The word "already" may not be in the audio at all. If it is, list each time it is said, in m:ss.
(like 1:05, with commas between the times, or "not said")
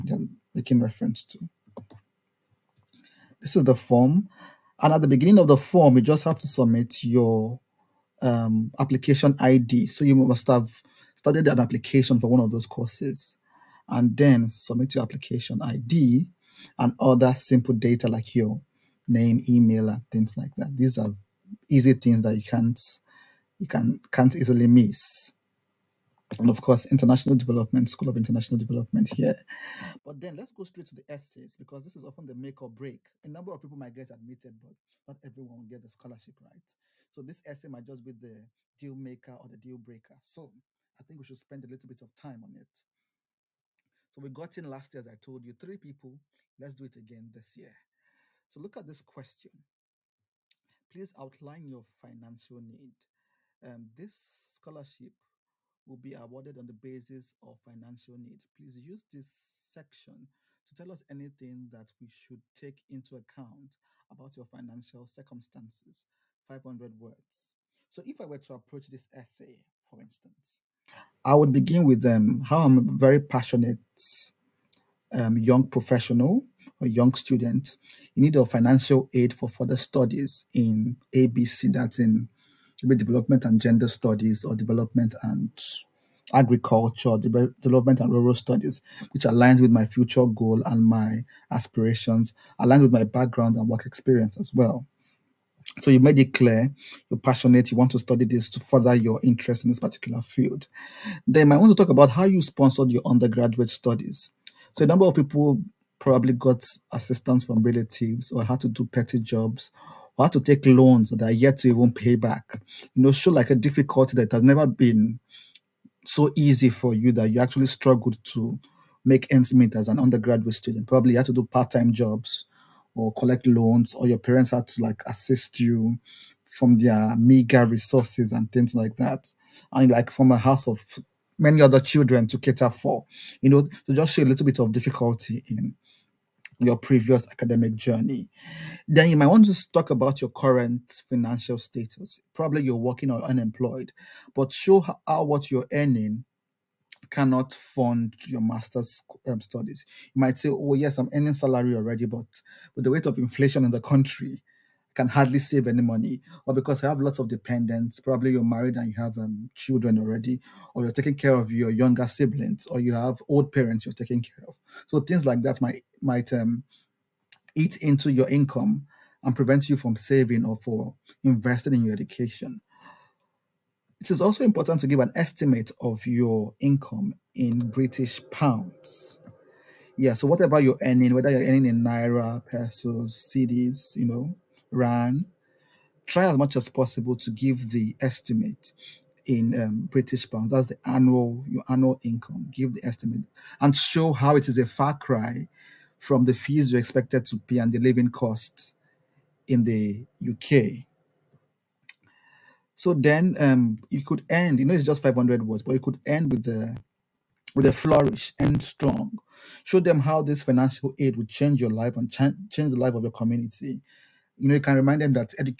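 2:31, 2:39.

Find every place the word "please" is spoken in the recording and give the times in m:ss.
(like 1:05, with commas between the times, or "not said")
0:50, 0:58.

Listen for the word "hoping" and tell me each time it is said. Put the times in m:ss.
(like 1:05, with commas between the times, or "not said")
not said.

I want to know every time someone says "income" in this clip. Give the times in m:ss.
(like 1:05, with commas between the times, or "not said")
2:48, 2:56, 3:12.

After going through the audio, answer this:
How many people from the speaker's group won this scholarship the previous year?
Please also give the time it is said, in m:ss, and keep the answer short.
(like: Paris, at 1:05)
3, at 0:45.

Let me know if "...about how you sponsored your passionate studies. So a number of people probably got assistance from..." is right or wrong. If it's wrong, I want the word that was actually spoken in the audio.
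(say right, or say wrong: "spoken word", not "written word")
wrong: "undergraduate", not "passionate".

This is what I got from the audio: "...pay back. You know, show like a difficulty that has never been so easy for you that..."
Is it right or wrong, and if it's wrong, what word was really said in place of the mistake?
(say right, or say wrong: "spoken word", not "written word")
right.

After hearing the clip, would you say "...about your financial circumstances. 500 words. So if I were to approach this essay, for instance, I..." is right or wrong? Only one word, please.
right.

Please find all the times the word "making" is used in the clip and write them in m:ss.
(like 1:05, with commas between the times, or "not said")
0:00.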